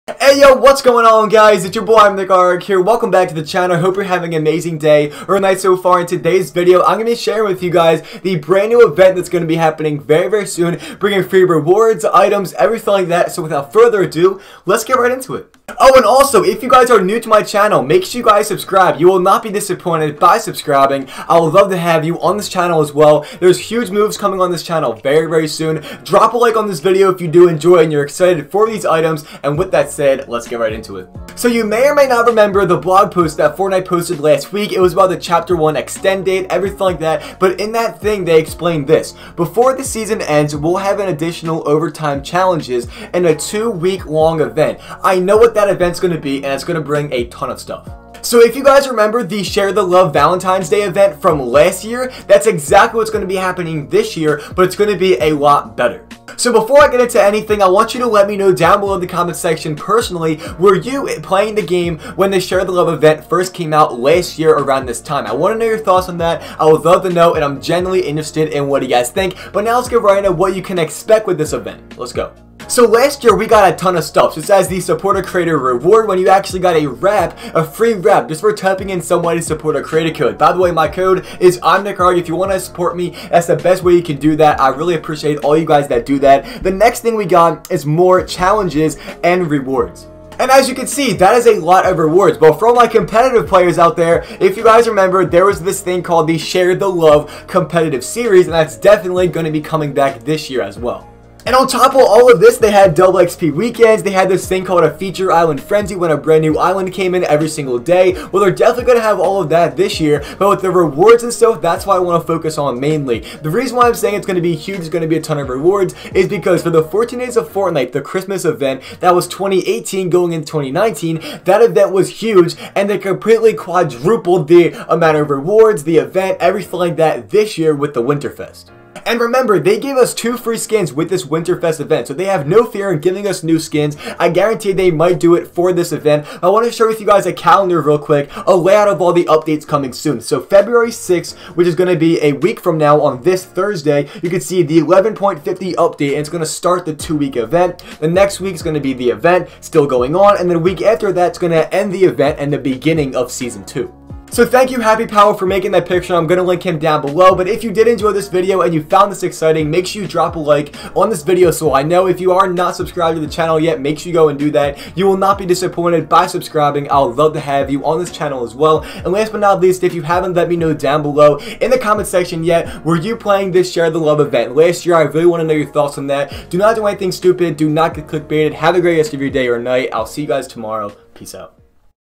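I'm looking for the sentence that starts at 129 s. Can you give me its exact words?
And remember, they gave us two free skins with this Winterfest event, so they have no fear in giving us new skins.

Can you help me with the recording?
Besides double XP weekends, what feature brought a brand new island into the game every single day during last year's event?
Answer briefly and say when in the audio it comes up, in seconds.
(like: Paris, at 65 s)
Feature island frenzy, at 104 s.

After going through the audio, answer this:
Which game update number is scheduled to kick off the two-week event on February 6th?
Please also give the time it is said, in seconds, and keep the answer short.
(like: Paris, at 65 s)
11.50, at 144 s.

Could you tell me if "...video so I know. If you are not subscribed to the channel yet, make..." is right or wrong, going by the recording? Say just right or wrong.
right.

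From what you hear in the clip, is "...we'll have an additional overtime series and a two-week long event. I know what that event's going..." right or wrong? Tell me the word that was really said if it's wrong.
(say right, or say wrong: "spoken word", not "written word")
wrong: "challenges", not "series".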